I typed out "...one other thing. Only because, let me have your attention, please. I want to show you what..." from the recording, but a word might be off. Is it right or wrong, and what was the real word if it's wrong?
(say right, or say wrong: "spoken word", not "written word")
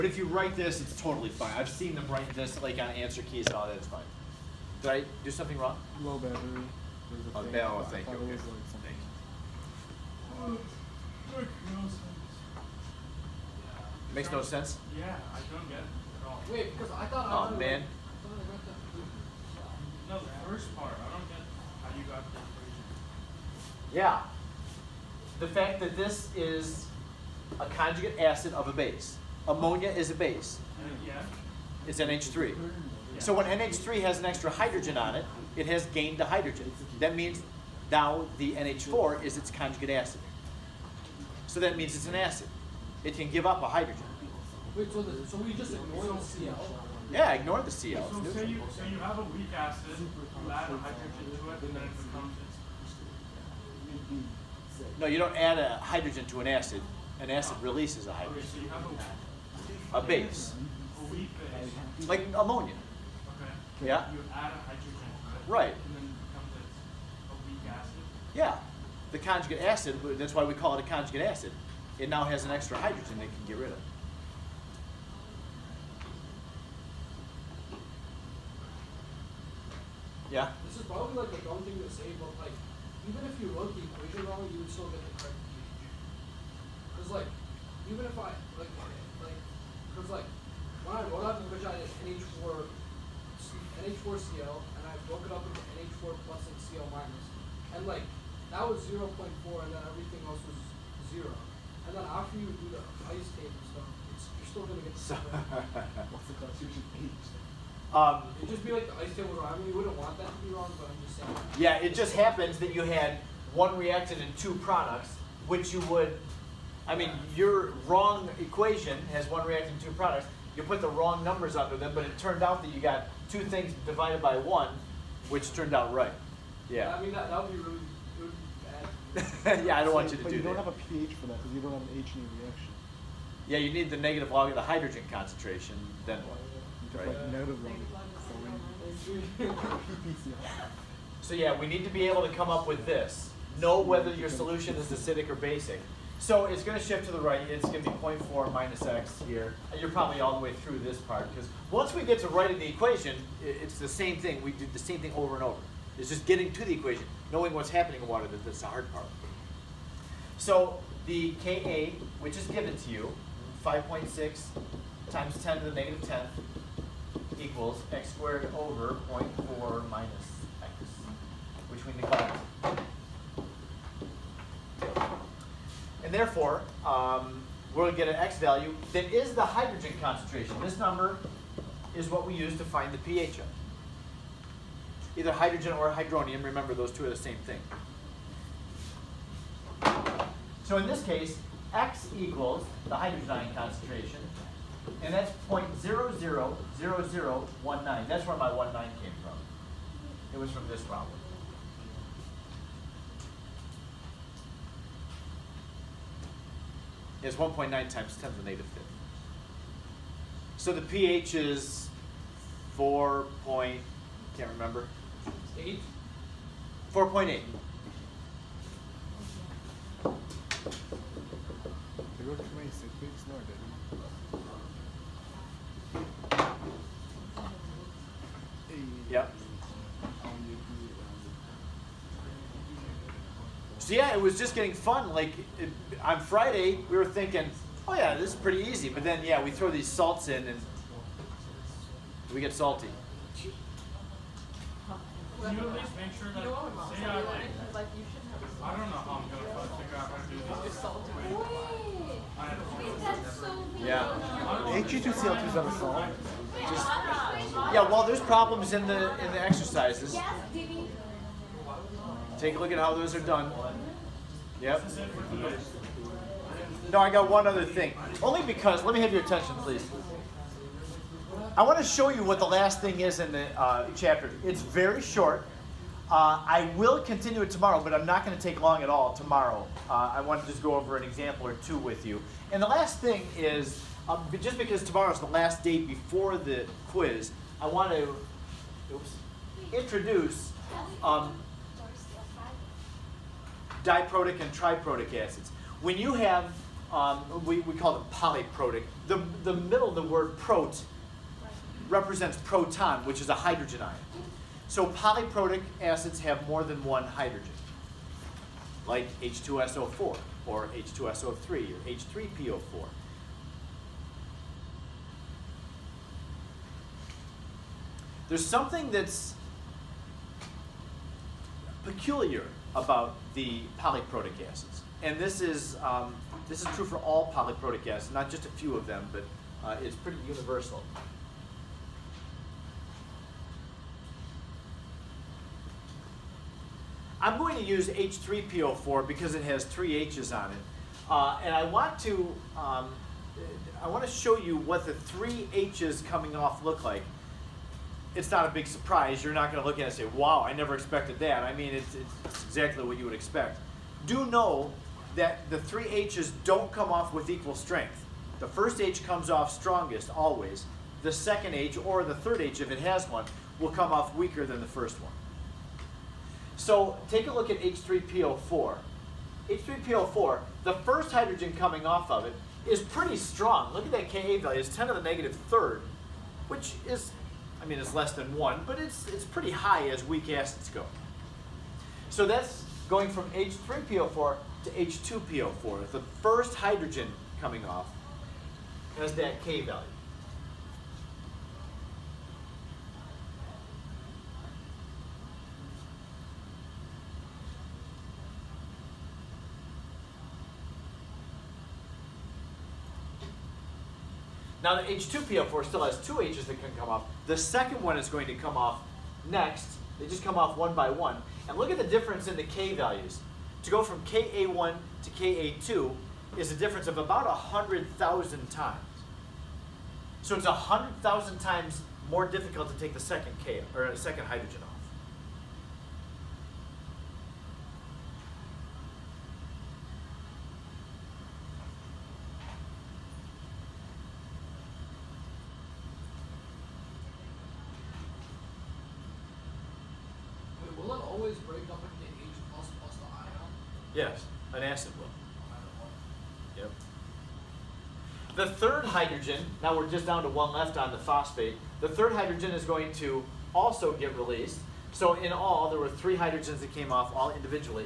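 right.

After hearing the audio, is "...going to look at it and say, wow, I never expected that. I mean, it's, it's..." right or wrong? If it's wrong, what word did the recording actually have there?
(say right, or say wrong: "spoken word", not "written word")
right.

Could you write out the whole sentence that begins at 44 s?
Wait, so, the, so we just ignore the CL?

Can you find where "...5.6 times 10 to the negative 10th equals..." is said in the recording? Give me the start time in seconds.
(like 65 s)
163 s.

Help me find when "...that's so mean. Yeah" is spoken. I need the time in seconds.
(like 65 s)
252 s.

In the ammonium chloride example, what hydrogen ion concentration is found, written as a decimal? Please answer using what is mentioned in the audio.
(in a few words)
0.000019.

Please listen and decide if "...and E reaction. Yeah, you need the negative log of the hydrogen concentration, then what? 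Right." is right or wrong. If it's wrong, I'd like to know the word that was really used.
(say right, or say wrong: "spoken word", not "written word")
right.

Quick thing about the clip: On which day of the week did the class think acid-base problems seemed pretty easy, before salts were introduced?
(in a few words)
Friday.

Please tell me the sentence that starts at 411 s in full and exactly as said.
And look at the difference in the K values.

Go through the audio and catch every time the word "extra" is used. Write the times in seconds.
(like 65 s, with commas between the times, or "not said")
34 s, 72 s.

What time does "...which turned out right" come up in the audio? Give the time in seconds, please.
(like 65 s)
125 s.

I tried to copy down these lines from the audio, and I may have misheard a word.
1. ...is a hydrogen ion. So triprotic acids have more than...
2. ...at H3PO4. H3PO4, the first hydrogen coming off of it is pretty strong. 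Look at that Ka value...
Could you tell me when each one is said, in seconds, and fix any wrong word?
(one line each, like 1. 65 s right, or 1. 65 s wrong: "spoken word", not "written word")
1. 303 s wrong: "polyprotic", not "triprotic"
2. 367 s right.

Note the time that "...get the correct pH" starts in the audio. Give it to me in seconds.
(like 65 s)
84 s.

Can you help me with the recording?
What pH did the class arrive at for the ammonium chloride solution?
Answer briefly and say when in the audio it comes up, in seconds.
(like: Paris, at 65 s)
4.8, at 216 s.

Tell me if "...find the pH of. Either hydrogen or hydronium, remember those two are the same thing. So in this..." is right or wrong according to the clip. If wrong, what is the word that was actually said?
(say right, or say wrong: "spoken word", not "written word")
right.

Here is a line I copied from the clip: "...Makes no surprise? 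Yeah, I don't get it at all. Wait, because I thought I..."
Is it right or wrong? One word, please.
wrong.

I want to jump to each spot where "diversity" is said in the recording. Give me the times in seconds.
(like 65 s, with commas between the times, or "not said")
not said.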